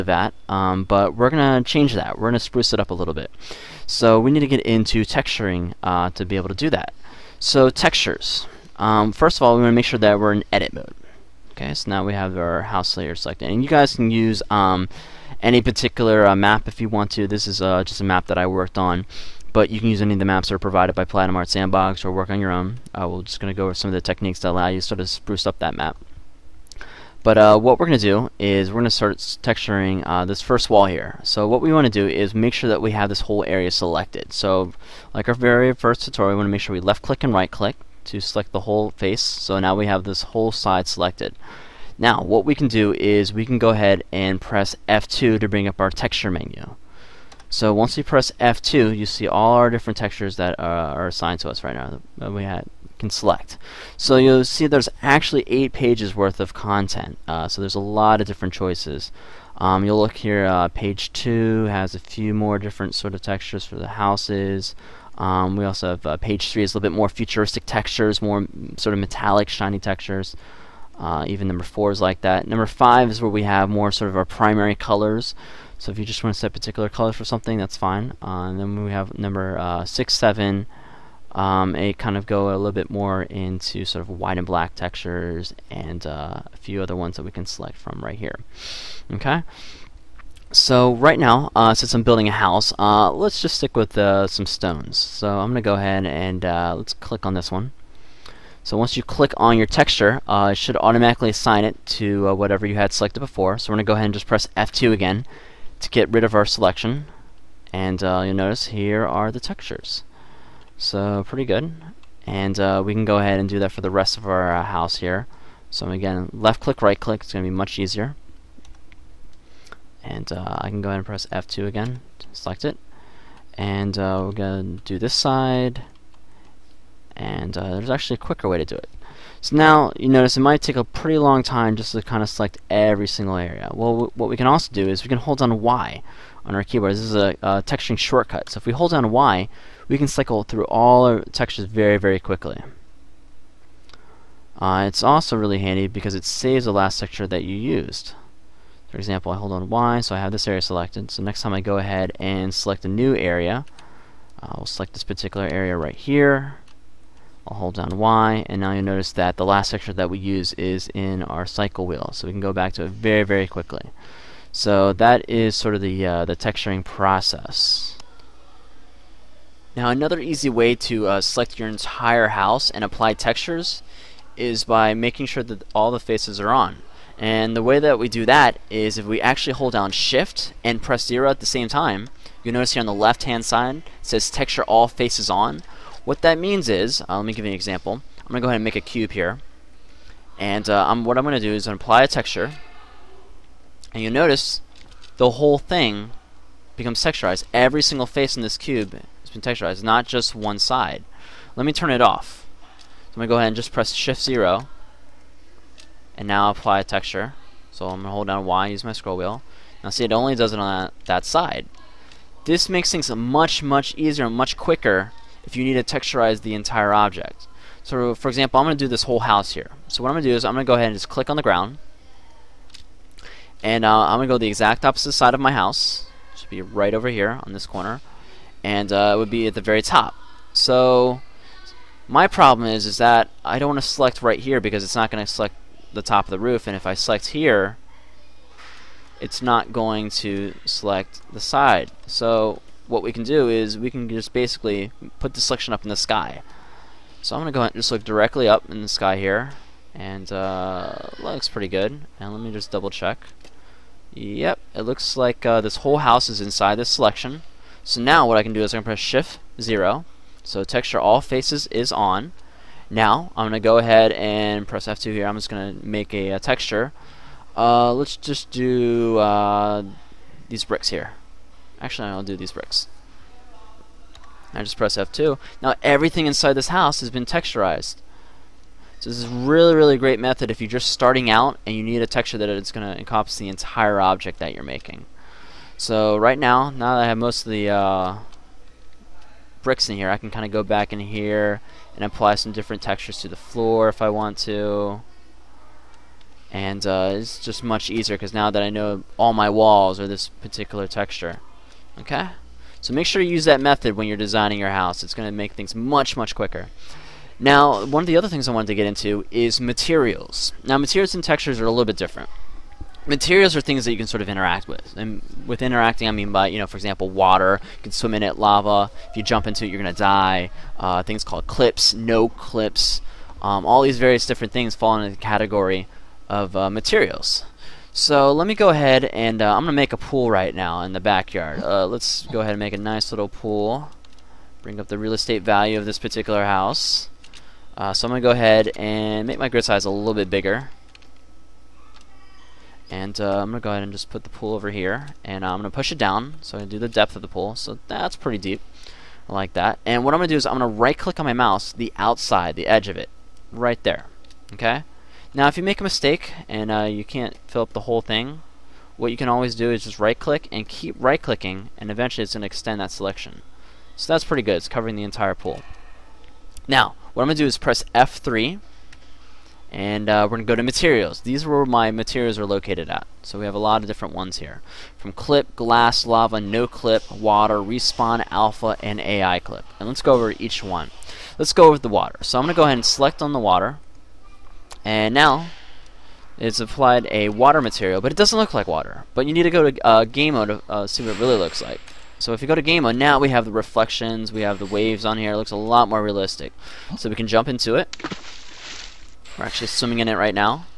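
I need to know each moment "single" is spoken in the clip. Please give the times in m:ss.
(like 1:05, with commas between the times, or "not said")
2:13, 3:17.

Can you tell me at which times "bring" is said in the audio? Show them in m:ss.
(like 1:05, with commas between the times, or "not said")
0:45, 5:34.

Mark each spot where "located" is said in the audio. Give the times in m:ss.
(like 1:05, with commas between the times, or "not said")
6:12.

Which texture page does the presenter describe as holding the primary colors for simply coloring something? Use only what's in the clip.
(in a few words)
5.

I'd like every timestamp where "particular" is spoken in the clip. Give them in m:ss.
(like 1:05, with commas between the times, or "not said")
0:15, 1:16, 2:35, 5:00, 5:35.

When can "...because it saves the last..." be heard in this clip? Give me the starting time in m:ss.
2:25.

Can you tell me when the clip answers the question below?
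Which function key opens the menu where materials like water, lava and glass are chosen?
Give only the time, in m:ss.
6:07.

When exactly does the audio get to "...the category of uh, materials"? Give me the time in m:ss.
5:25.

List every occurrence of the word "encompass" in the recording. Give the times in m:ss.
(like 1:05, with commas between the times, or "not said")
4:42.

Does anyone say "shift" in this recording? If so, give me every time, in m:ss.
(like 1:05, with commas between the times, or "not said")
2:59, 3:23, 4:18.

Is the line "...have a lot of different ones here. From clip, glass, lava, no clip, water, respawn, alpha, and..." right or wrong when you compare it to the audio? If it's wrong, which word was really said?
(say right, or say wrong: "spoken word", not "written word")
right.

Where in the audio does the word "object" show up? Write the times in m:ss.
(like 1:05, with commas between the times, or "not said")
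3:36, 4:44.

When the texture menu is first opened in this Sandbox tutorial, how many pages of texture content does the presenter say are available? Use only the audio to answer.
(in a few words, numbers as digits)
8.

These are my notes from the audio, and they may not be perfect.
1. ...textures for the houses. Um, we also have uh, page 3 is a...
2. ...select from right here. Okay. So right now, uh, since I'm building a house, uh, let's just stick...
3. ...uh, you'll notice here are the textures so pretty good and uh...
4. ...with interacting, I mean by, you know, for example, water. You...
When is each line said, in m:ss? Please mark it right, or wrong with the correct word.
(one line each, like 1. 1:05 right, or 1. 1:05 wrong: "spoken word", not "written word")
1. 1:03 right
2. 1:27 right
3. 1:48 right
4. 5:15 right.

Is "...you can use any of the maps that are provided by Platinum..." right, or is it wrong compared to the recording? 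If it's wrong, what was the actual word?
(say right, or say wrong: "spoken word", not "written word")
right.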